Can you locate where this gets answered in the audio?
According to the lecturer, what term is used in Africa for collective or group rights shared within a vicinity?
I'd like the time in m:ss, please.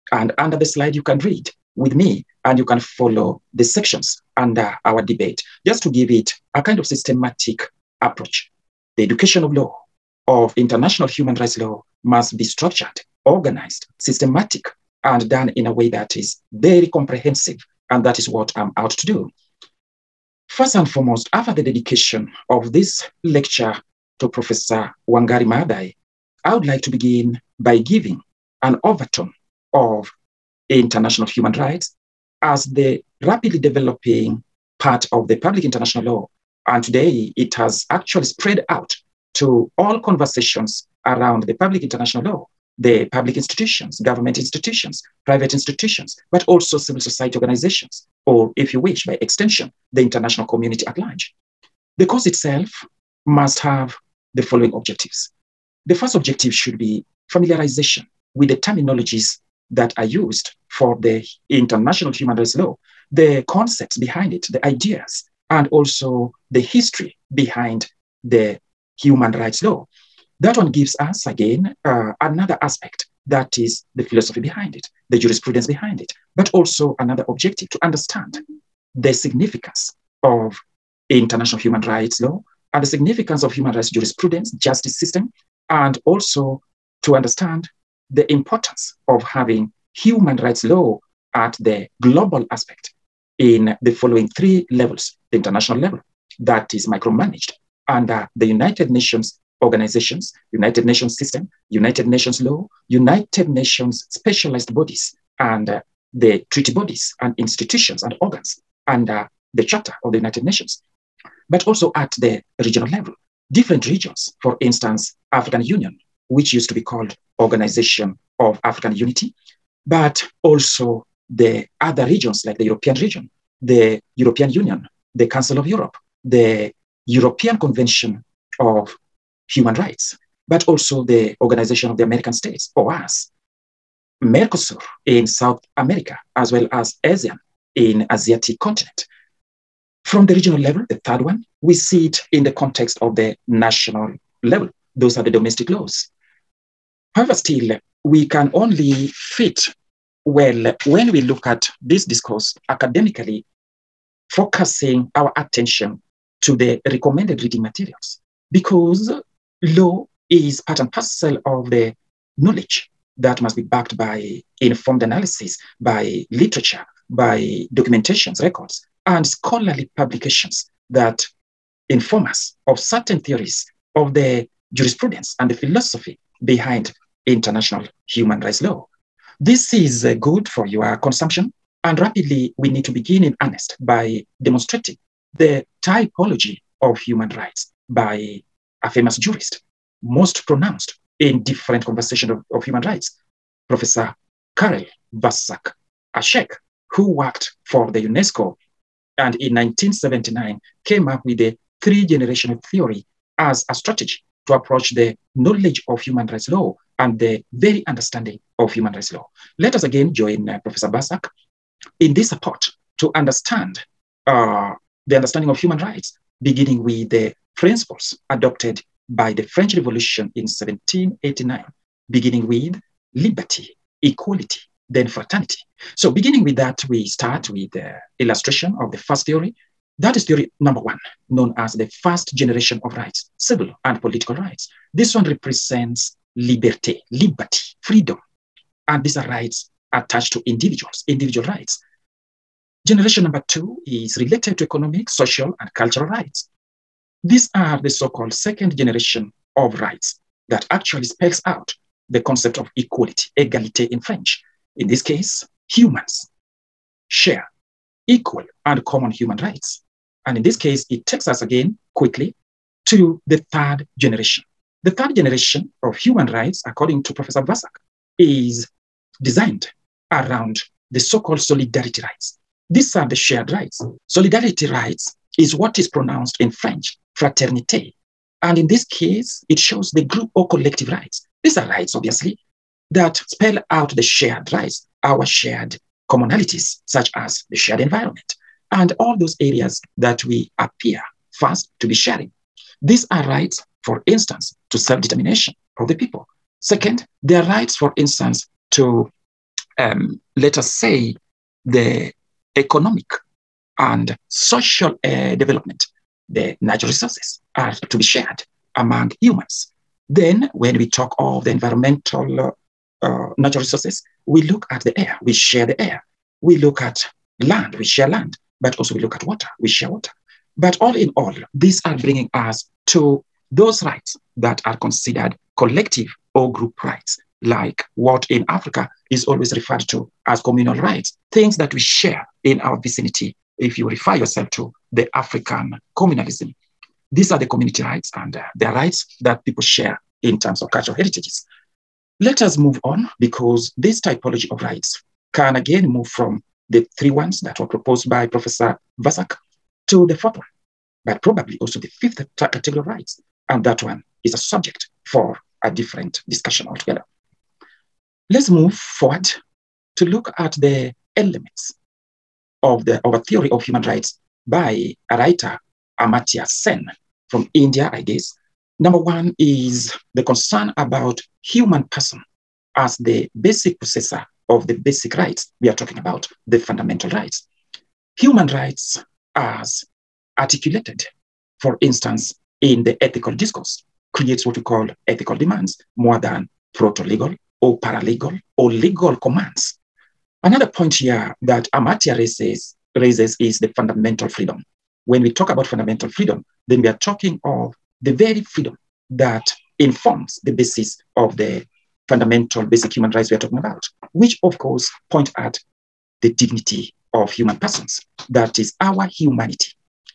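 5:30.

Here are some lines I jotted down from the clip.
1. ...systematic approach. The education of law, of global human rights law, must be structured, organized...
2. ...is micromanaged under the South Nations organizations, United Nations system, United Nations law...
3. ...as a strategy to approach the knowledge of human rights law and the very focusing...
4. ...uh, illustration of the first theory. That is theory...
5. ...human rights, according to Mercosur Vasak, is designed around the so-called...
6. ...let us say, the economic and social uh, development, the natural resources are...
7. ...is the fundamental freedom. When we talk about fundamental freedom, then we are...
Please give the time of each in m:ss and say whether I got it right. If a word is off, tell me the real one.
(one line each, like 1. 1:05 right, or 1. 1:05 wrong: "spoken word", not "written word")
1. 0:06 wrong: "international", not "global"
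2. 1:36 wrong: "United", not "South"
3. 3:23 wrong: "understanding", not "focusing"
4. 3:47 right
5. 4:25 wrong: "Professor", not "Mercosur"
6. 5:00 right
7. 6:33 right.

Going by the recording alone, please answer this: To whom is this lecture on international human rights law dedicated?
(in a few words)
Professor Wangari Maathai.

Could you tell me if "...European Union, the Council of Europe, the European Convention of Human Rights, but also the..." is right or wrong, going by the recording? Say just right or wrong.
right.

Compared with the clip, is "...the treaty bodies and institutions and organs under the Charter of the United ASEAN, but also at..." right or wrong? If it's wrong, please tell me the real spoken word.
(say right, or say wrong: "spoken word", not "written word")
wrong: "Nations", not "ASEAN".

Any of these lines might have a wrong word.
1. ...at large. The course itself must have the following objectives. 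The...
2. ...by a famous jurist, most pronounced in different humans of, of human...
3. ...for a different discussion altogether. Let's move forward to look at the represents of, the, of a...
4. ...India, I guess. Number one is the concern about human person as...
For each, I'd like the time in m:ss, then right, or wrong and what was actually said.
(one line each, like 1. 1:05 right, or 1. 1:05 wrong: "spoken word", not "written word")
1. 0:50 right
2. 3:07 wrong: "conversations", not "humans"
3. 5:55 wrong: "elements", not "represents"
4. 6:07 right.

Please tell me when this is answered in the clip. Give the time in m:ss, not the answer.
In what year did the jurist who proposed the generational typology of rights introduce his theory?
3:19.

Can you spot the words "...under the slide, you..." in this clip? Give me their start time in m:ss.
0:00.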